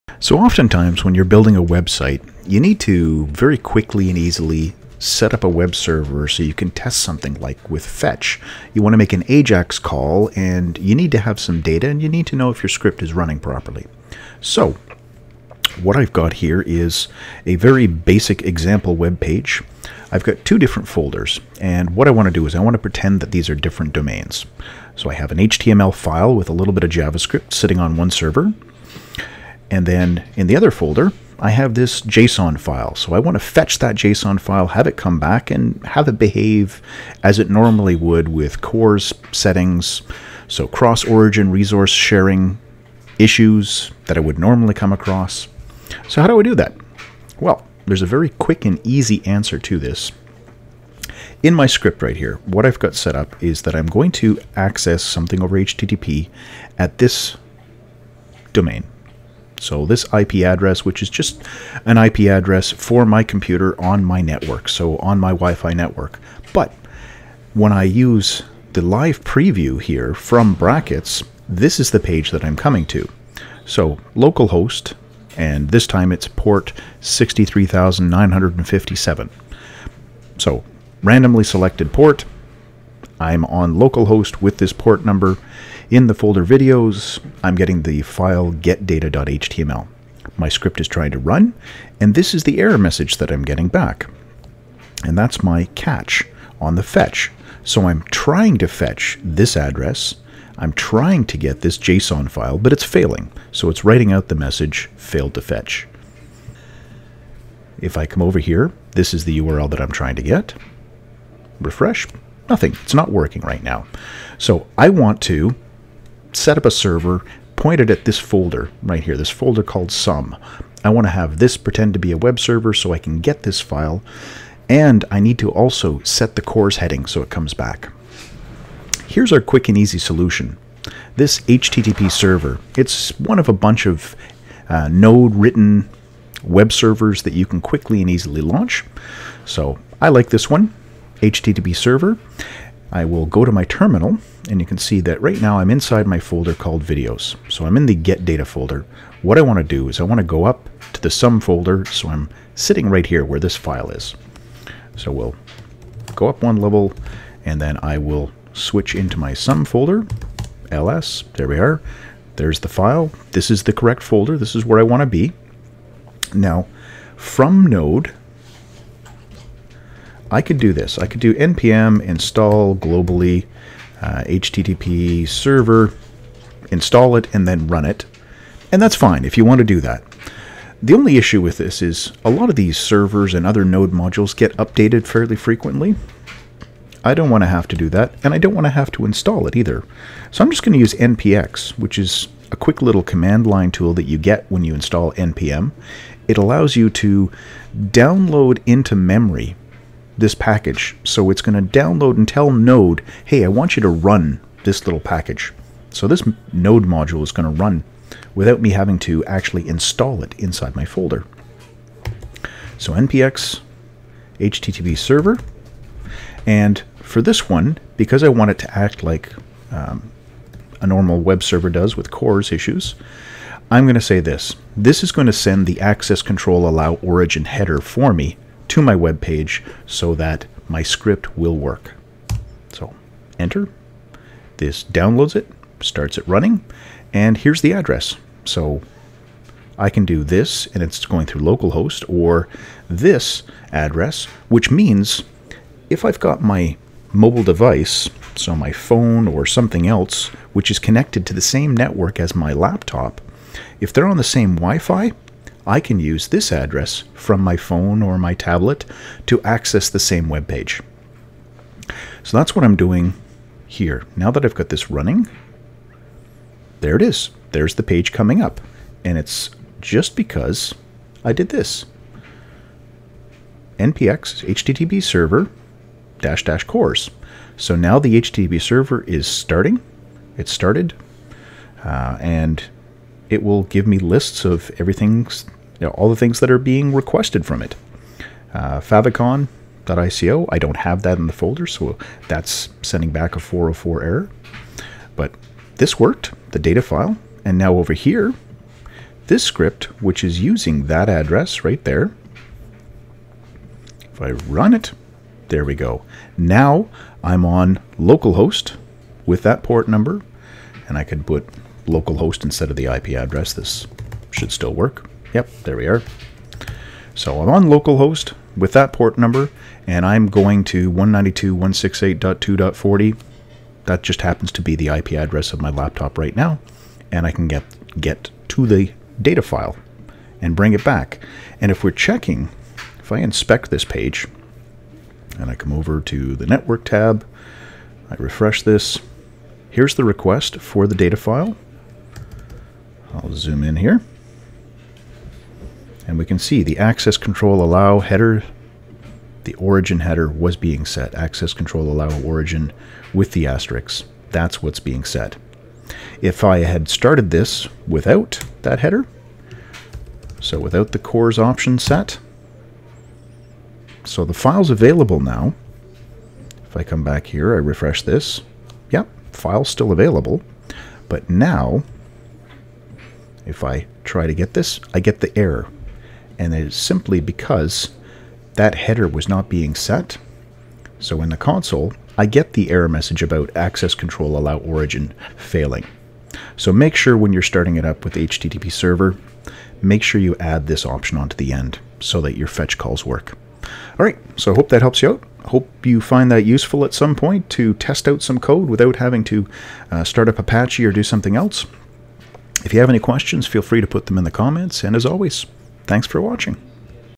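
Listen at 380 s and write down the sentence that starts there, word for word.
So in the console, I get the error message about access control allow origin failing.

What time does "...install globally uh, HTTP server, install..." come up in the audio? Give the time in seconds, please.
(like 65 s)
172 s.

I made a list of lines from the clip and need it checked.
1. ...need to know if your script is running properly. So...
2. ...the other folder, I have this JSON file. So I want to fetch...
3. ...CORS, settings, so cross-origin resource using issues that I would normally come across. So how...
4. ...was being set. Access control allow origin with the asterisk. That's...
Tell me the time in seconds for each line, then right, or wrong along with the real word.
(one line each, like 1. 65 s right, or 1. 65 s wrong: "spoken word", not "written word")
1. 12 s right
2. 30 s right
3. 38 s wrong: "sharing", not "using"
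4. 350 s right.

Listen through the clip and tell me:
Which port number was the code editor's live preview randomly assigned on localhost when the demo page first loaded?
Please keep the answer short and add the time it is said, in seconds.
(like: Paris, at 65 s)
63957, at 77 s.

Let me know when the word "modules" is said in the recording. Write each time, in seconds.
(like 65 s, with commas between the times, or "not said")
183 s, 206 s.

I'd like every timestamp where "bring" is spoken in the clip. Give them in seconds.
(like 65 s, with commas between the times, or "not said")
330 s.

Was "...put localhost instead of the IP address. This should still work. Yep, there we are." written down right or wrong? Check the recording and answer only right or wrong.
right.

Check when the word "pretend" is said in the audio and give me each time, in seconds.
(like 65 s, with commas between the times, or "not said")
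22 s, 121 s.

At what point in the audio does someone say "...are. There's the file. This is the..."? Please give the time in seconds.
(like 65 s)
161 s.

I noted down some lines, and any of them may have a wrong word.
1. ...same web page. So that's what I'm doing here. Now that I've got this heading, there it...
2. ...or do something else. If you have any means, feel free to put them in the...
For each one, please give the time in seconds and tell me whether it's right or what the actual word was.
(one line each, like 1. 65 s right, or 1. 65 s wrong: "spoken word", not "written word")
1. 260 s wrong: "running", not "heading"
2. 400 s wrong: "questions", not "means".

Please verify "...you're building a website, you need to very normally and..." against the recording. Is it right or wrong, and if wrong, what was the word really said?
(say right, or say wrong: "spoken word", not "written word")
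wrong: "quickly", not "normally".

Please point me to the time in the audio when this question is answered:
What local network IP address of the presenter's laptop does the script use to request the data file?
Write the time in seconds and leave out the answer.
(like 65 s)
320 s.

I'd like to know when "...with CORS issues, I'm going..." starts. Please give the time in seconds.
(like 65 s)
221 s.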